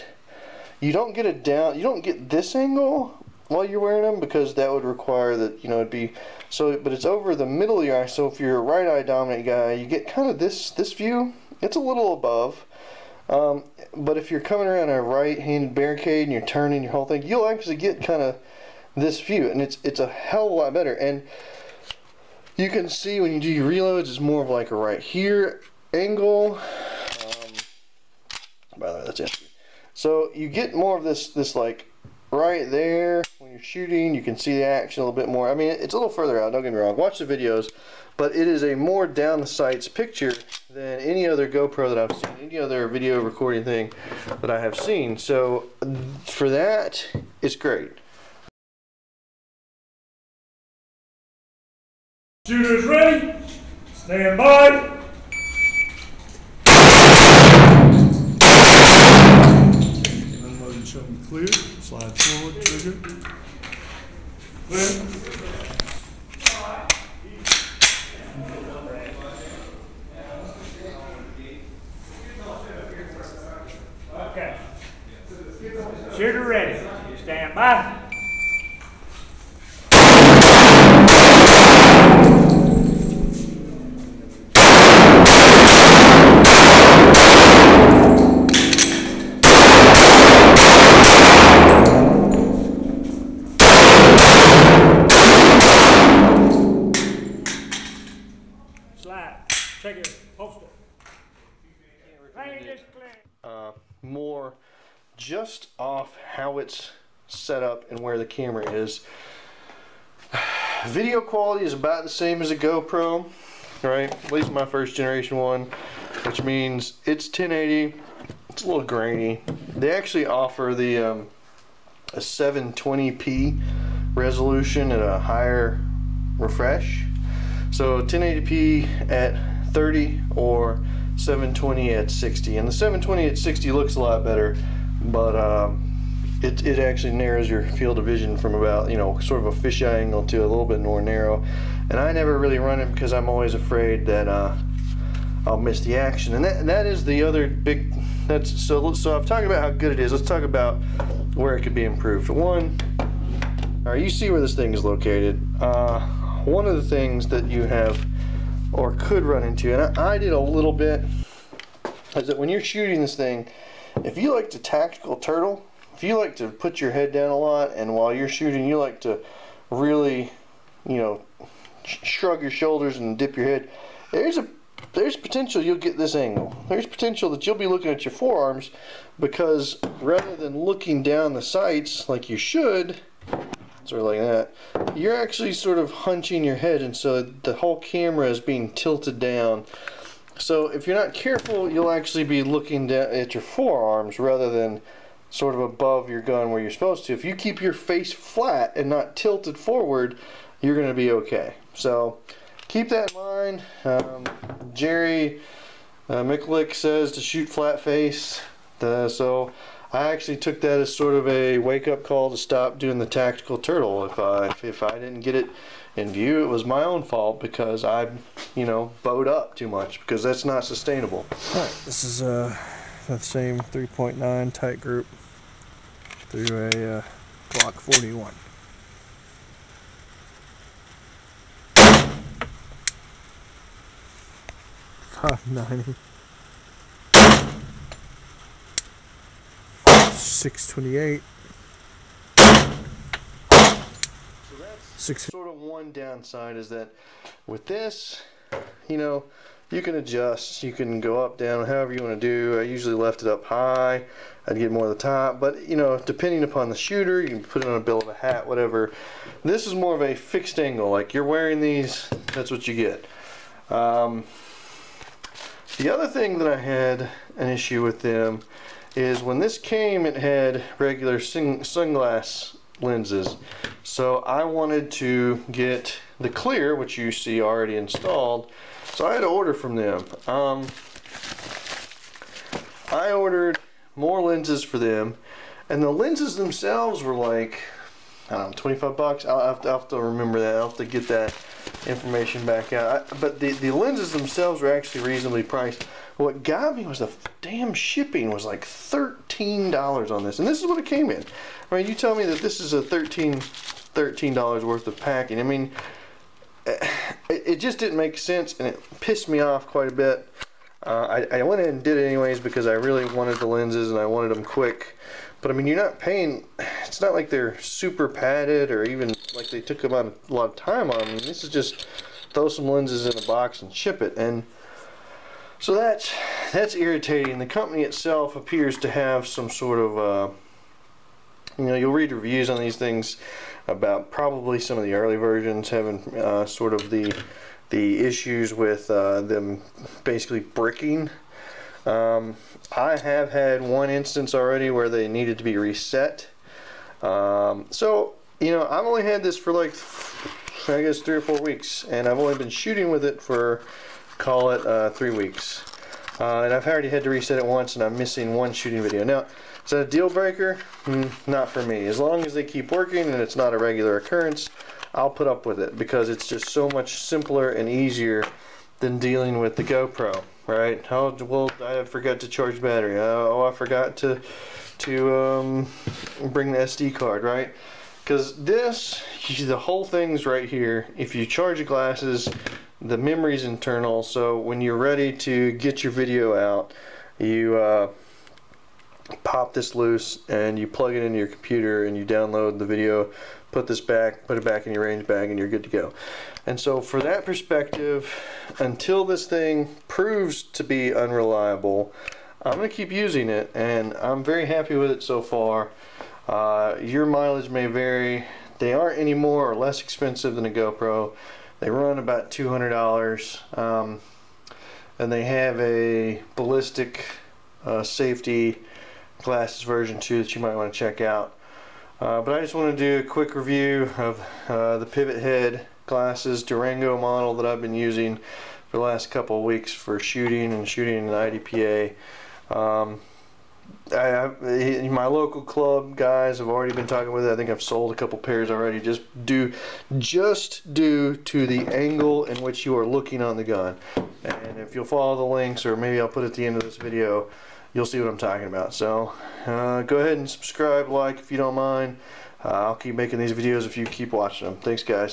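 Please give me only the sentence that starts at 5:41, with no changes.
Um, I have had one instance already where they needed to be reset.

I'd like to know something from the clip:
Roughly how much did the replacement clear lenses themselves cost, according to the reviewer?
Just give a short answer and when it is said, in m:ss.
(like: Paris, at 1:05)
$25, at 4:48.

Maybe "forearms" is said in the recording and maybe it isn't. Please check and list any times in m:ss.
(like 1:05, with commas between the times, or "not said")
2:58, 3:13.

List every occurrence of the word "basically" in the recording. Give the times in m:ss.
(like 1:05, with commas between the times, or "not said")
5:40.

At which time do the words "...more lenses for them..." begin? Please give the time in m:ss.
4:43.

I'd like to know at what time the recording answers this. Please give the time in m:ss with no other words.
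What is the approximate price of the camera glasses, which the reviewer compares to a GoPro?
6:52.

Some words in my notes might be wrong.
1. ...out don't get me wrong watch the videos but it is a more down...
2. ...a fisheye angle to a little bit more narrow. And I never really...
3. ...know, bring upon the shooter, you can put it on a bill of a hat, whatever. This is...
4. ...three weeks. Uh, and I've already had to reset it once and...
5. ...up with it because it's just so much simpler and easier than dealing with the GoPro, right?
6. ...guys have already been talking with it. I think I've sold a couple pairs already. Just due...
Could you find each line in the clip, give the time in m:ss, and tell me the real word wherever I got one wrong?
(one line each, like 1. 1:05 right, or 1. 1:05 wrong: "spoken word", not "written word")
1. 0:36 right
2. 2:19 right
3. 4:15 wrong: "depending", not "bring"
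4. 5:54 right
5. 6:05 right
6. 7:15 right.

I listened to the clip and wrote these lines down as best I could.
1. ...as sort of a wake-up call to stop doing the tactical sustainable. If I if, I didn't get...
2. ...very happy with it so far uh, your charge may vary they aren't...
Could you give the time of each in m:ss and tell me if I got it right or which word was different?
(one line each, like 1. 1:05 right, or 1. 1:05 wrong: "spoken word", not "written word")
1. 3:30 wrong: "turtle", not "sustainable"
2. 6:44 wrong: "mileage", not "charge".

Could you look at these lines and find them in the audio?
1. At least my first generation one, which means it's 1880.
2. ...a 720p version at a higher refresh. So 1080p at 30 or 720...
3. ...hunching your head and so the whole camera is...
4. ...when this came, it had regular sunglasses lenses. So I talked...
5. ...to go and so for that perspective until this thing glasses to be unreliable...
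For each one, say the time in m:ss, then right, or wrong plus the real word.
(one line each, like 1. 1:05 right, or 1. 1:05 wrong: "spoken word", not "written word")
1. 1:54 wrong: "1080", not "1880"
2. 2:02 wrong: "resolution", not "version"
3. 3:05 right
4. 4:29 wrong: "wanted", not "talked"
5. 6:35 wrong: "proves", not "glasses".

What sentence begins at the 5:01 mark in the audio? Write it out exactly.
I mean, you tell me that this is a 13 $13 worth of packing.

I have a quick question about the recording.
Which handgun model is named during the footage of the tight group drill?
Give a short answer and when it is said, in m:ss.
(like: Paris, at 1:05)
Glock 41, at 3:47.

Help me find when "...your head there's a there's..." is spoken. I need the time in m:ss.
2:53.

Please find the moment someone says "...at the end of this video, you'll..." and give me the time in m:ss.
7:26.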